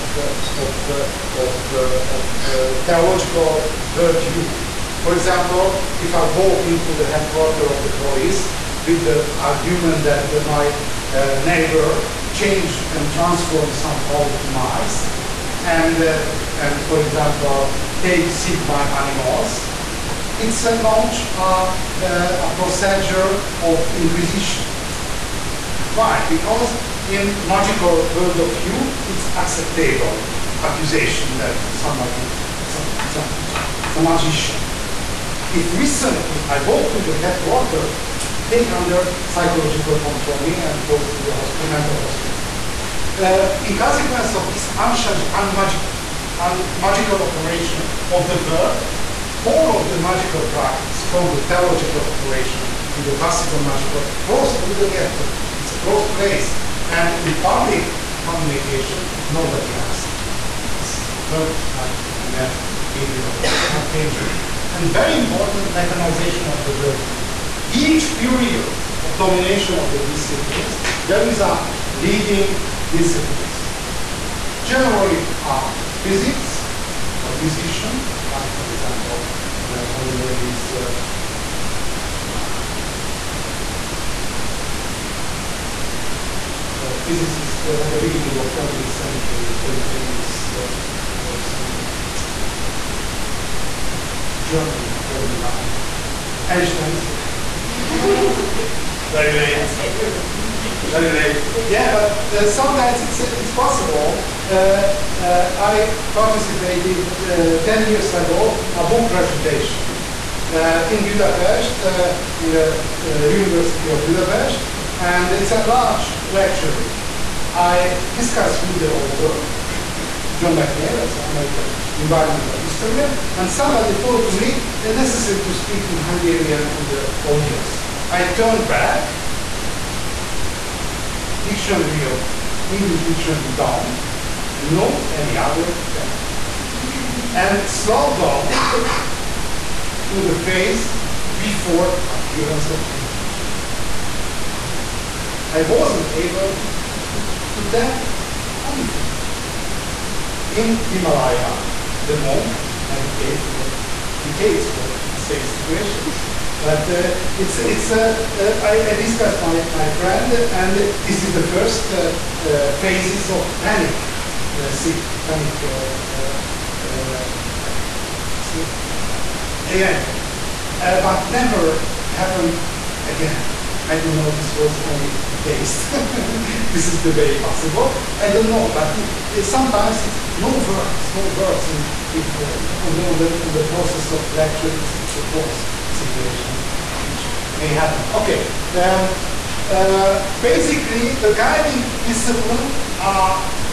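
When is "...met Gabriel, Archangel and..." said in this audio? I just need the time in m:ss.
1:02.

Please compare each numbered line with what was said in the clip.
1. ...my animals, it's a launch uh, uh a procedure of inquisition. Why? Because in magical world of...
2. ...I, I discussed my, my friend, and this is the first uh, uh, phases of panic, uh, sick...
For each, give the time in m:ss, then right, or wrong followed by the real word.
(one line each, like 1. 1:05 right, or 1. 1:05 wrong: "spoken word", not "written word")
1. 0:18 right
2. 2:38 right.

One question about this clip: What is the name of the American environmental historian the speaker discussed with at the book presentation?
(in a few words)
John McNeill.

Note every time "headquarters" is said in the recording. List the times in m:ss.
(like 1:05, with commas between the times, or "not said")
0:07, 0:37.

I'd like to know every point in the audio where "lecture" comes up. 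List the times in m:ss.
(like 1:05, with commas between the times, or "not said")
1:56, 3:04.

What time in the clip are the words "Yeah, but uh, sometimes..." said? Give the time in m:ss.
1:41.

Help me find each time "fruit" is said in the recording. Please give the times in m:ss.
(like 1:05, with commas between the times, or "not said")
not said.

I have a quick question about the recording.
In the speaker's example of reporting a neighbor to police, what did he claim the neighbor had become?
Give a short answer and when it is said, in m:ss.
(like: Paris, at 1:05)
mice, at 0:14.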